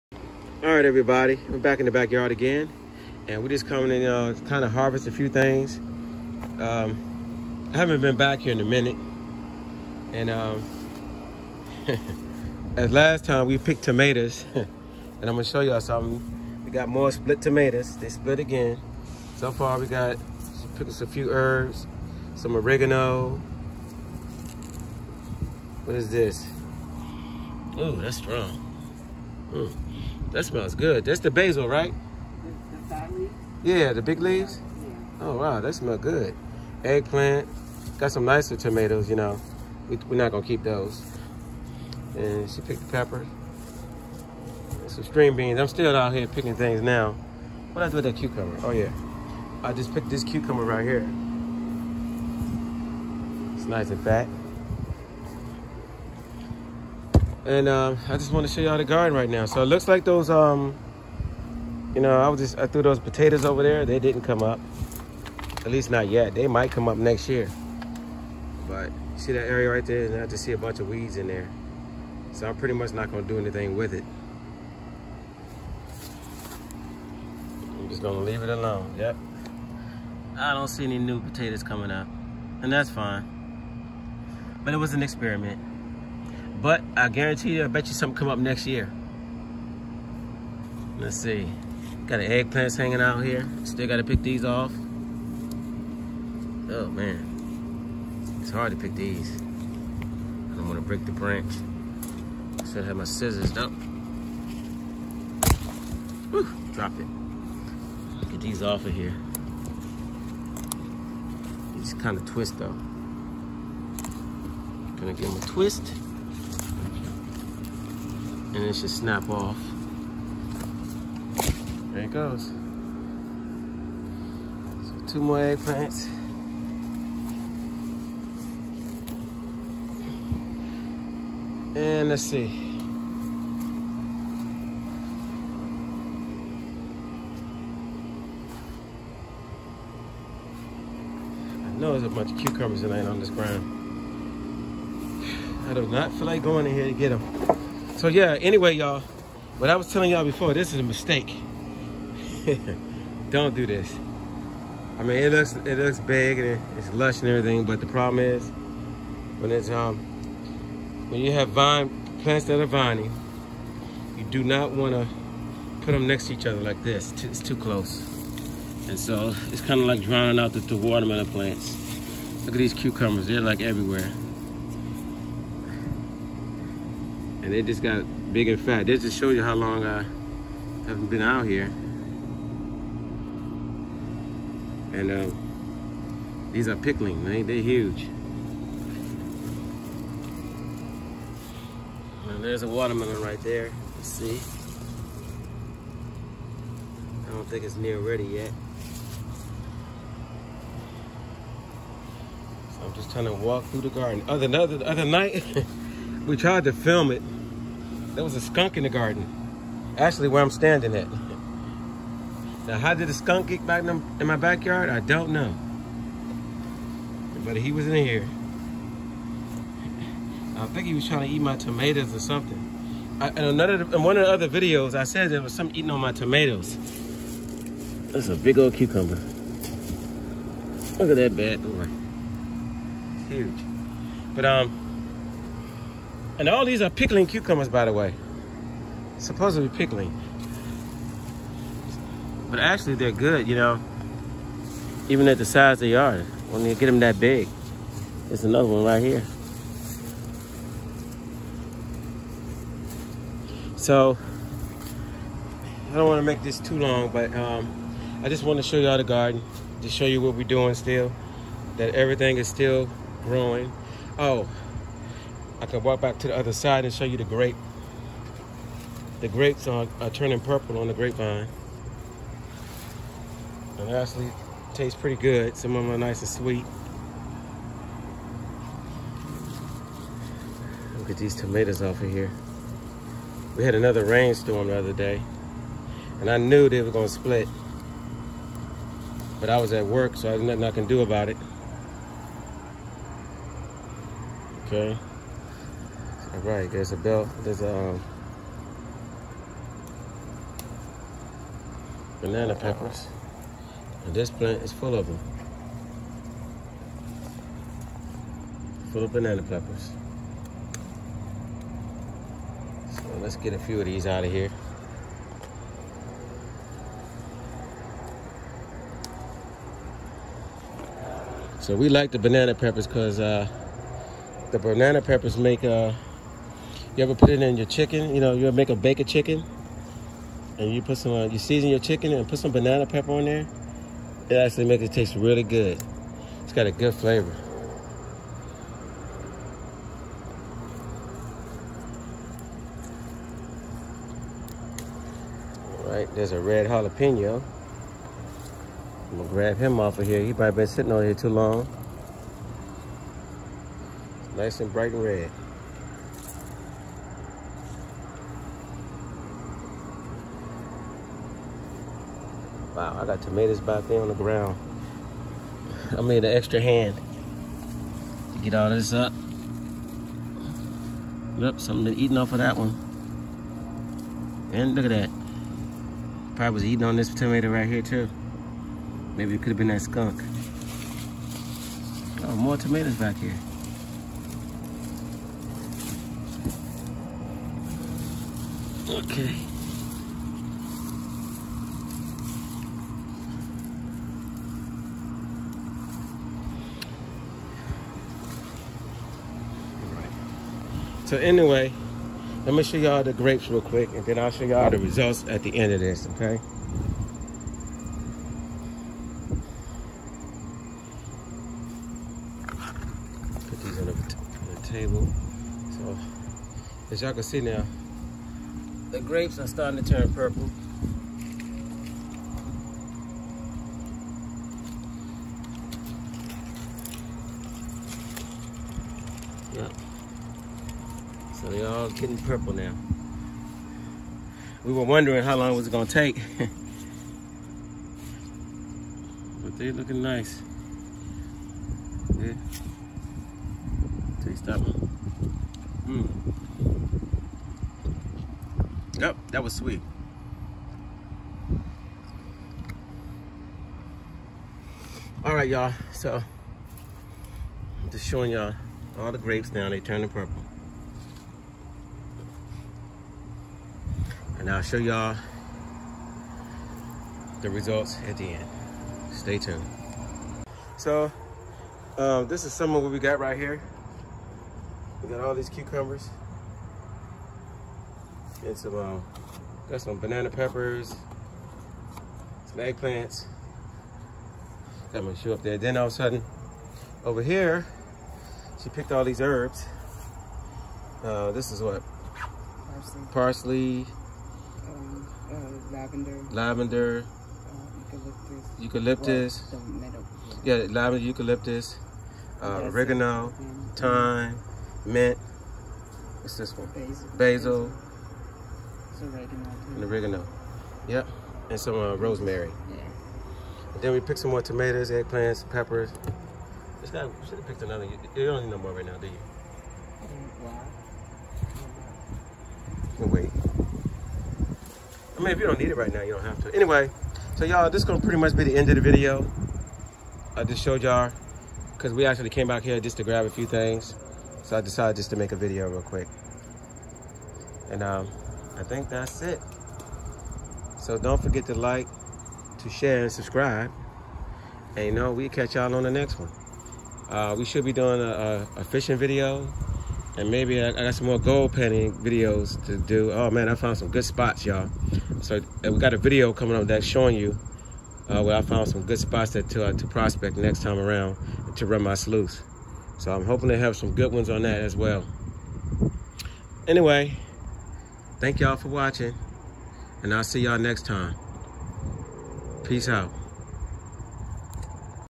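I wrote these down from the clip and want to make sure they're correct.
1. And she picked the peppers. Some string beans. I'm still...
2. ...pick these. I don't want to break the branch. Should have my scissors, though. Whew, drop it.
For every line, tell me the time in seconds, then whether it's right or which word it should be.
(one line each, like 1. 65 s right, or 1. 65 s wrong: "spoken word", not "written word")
1. 42 s right
2. 98 s right.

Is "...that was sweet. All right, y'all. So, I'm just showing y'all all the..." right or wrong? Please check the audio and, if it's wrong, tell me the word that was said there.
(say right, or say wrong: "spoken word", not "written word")
right.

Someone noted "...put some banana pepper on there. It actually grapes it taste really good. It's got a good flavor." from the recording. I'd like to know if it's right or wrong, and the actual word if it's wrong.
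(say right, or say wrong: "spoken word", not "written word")
wrong: "makes", not "grapes".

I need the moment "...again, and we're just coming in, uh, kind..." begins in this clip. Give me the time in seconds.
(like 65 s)
2 s.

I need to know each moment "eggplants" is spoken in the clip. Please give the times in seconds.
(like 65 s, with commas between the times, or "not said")
36 s, 92 s, 125 s, 482 s, 514 s.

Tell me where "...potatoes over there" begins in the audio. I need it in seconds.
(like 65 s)
62 s.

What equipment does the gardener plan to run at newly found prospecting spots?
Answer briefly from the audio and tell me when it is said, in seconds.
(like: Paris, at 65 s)
sluice, at 561 s.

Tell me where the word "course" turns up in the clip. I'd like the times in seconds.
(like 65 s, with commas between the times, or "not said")
not said.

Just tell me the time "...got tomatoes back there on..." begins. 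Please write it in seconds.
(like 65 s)
363 s.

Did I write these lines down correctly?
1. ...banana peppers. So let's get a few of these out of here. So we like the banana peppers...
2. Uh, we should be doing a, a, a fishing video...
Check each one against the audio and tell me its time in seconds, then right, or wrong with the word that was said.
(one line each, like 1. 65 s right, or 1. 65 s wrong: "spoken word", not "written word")
1. 309 s right
2. 547 s right.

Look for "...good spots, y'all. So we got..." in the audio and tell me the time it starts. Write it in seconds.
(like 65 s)
553 s.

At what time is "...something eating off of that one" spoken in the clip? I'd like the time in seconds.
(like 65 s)
371 s.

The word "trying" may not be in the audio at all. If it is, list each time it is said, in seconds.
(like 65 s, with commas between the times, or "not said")
203 s, 221 s.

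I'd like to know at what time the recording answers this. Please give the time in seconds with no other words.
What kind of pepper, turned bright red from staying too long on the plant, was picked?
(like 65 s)
346 s.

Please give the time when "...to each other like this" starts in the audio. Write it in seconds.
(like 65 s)
166 s.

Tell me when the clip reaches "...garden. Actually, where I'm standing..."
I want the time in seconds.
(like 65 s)
208 s.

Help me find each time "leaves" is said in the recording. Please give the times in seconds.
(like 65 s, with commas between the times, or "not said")
34 s, 78 s.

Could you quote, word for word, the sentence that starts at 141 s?
I know there's a bunch of cucumbers laying on this ground.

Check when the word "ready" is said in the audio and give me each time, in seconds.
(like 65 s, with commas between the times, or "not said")
197 s.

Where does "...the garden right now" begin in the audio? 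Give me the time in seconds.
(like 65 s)
58 s.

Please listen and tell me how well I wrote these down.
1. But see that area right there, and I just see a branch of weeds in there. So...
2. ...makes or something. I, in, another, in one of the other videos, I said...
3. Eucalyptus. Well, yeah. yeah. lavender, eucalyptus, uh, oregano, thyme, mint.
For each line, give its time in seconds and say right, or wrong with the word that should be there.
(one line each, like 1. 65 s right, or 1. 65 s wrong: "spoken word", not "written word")
1. 68 s wrong: "bunch", not "branch"
2. 221 s wrong: "tomatoes", not "makes"
3. 498 s right.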